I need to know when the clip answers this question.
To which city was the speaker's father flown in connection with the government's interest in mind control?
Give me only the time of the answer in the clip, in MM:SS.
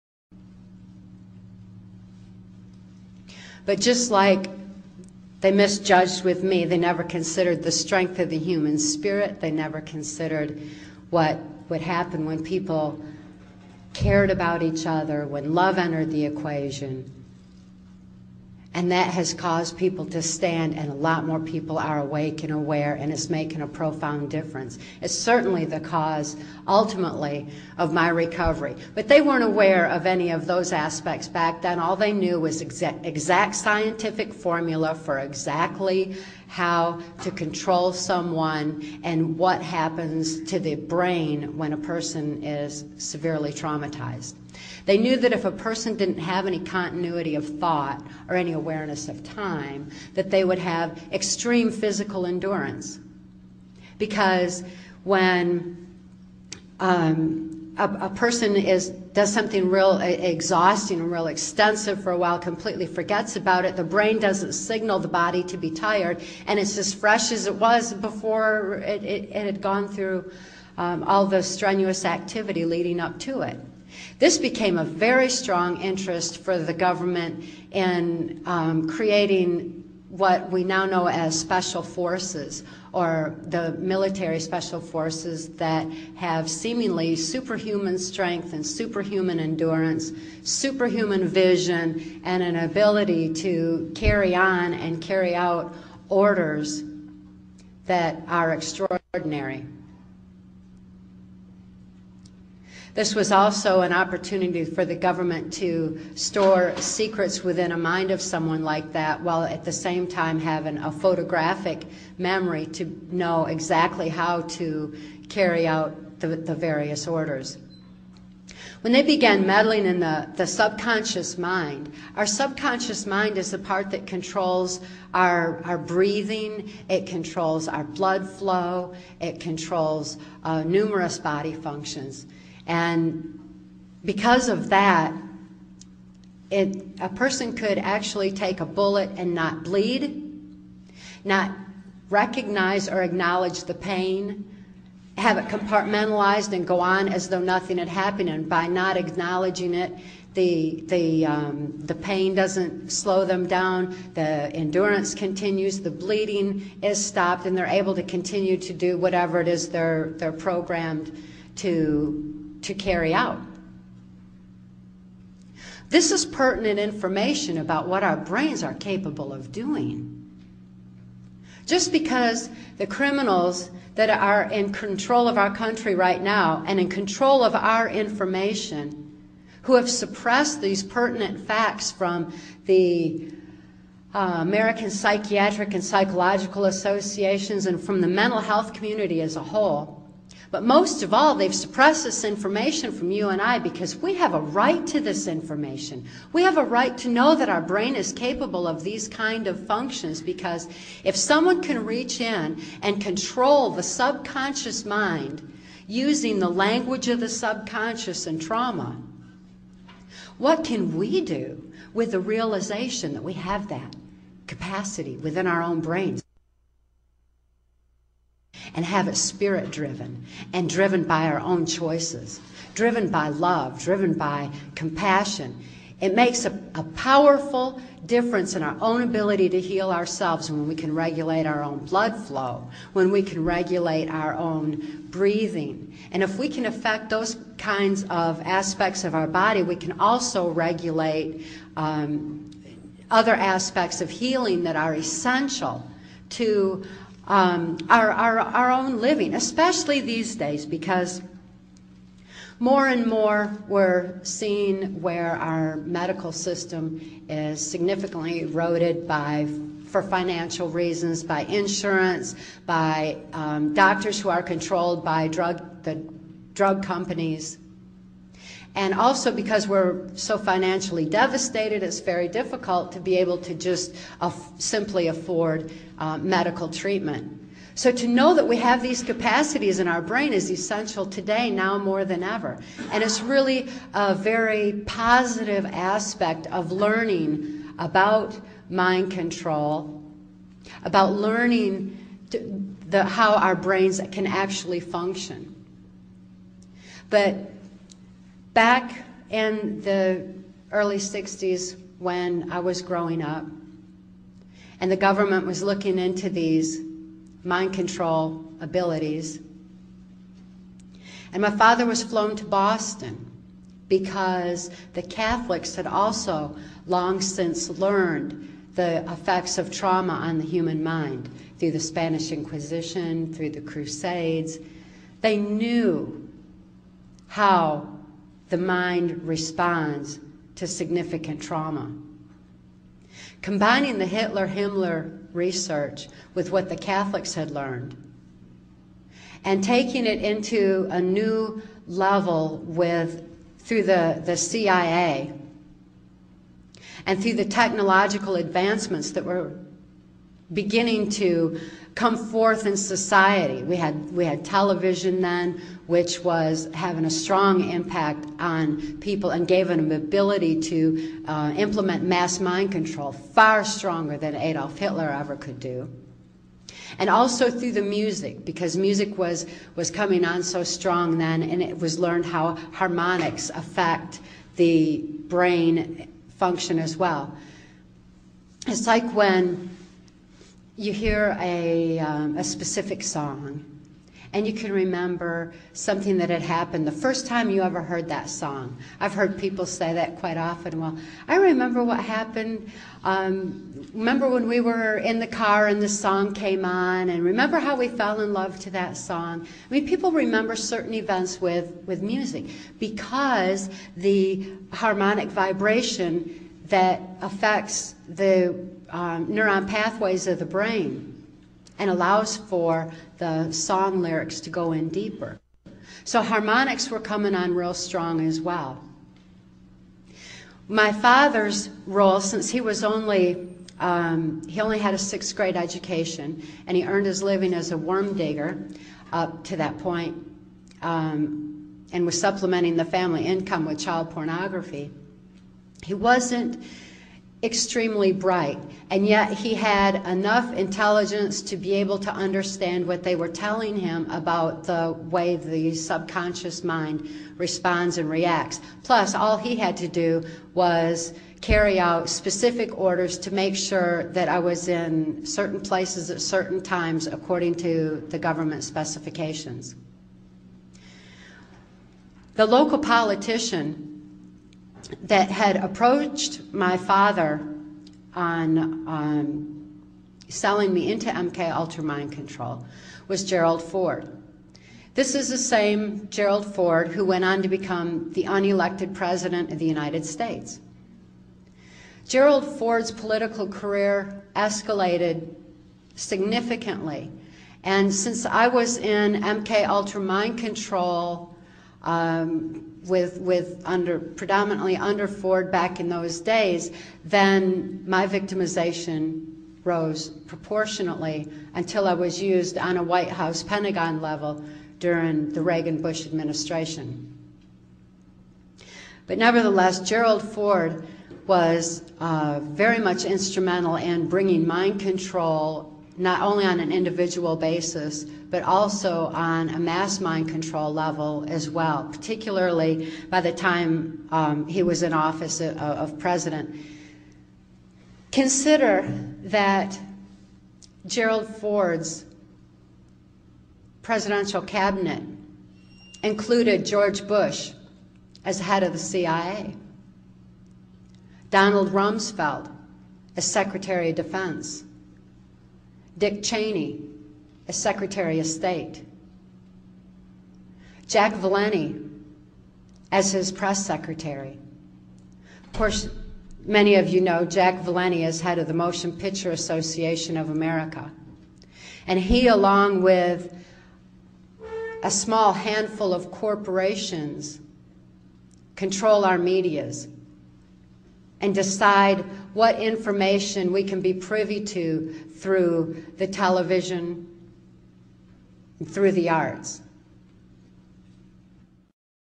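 05:12.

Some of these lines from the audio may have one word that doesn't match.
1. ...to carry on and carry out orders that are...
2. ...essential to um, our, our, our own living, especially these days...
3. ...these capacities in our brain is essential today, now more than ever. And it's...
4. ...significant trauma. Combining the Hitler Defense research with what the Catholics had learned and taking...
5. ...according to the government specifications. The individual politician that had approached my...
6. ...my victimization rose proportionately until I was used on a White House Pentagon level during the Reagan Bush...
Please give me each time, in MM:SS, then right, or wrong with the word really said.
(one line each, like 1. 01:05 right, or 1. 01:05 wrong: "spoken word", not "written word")
1. 01:33 right
2. 04:04 right
3. 04:38 right
4. 05:30 wrong: "Himmler", not "Defense"
5. 07:37 wrong: "local", not "individual"
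6. 08:17 right.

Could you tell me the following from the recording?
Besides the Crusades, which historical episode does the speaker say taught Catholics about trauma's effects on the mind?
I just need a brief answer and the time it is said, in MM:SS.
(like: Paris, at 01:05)
Spanish Inquisition, at 05:21.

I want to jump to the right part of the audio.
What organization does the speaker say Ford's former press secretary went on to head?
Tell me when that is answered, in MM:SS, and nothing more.
09:18.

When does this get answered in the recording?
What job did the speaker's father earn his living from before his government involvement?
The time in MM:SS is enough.
07:07.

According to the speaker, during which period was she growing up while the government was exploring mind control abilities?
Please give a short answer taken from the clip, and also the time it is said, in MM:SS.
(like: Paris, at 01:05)
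early 60s, at 05:00.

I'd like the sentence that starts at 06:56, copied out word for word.
So harmonics were coming on real strong as well.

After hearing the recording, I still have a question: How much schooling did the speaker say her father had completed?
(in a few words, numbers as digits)
sixth grade.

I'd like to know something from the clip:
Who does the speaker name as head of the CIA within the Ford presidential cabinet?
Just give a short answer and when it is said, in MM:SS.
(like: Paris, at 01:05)
George Bush, at 08:56.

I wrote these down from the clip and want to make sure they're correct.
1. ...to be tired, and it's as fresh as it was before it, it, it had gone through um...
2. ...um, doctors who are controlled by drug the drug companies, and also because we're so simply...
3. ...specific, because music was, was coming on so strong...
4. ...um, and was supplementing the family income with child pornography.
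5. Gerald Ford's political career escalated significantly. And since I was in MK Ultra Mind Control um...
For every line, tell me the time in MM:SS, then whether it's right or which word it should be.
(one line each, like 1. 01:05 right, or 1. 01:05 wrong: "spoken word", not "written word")
1. 01:05 right
2. 04:23 wrong: "financially", not "simply"
3. 06:07 wrong: "music", not "specific"
4. 07:10 right
5. 08:02 right.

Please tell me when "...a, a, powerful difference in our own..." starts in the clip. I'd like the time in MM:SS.
03:46.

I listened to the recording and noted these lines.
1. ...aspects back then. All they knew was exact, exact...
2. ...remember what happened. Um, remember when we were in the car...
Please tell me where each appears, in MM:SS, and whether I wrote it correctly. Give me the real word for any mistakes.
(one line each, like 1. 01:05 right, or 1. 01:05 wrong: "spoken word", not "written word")
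1. 00:30 right
2. 06:31 right.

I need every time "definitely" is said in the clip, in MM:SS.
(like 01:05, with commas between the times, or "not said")
not said.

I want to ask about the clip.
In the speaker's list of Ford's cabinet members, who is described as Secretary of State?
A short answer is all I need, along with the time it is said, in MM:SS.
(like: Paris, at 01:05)
Dick Cheney, at 09:06.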